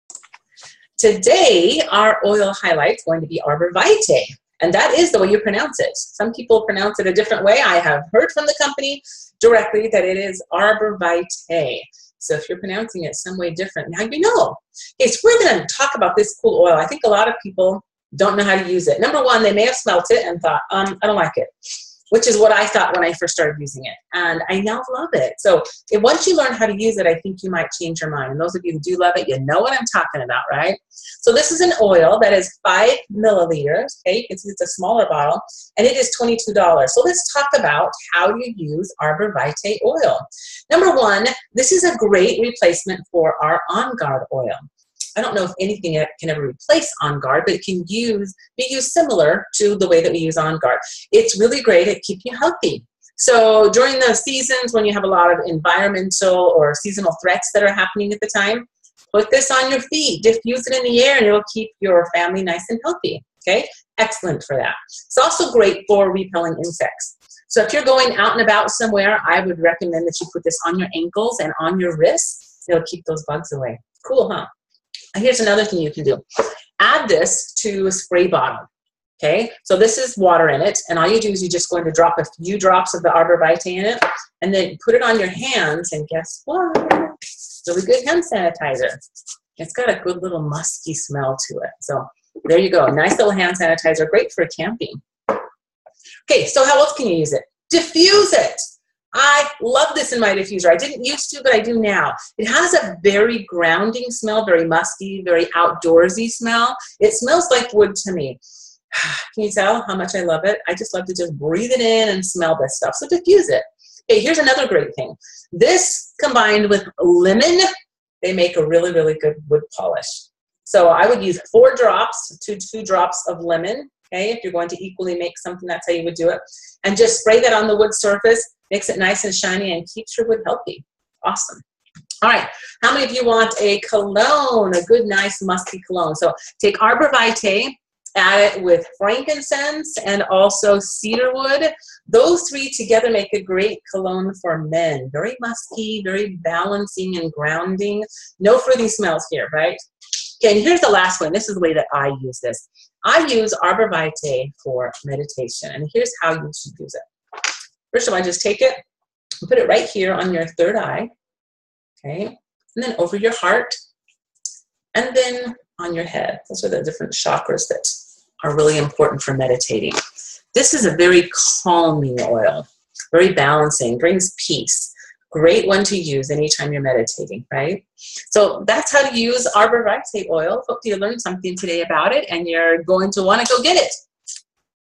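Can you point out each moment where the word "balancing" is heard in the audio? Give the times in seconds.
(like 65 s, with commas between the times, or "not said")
146 s, 173 s.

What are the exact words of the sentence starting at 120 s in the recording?
So I would use four drops to two drops of lemon.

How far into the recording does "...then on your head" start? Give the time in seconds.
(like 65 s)
165 s.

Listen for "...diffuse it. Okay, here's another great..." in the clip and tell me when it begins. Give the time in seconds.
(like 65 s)
113 s.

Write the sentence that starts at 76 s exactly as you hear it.
Add this to a spray bottle.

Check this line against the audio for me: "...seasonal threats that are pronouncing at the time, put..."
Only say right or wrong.
wrong.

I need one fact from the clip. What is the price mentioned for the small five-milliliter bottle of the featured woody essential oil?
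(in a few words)
$22.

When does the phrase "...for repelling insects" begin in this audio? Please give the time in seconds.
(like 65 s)
65 s.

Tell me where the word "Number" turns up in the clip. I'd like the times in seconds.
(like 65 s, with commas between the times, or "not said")
19 s, 40 s.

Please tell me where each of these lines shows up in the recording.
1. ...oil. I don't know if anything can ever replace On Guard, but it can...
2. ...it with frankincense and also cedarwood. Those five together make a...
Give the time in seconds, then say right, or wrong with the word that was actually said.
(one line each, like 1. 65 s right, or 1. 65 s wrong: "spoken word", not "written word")
1. 44 s right
2. 138 s wrong: "three", not "five".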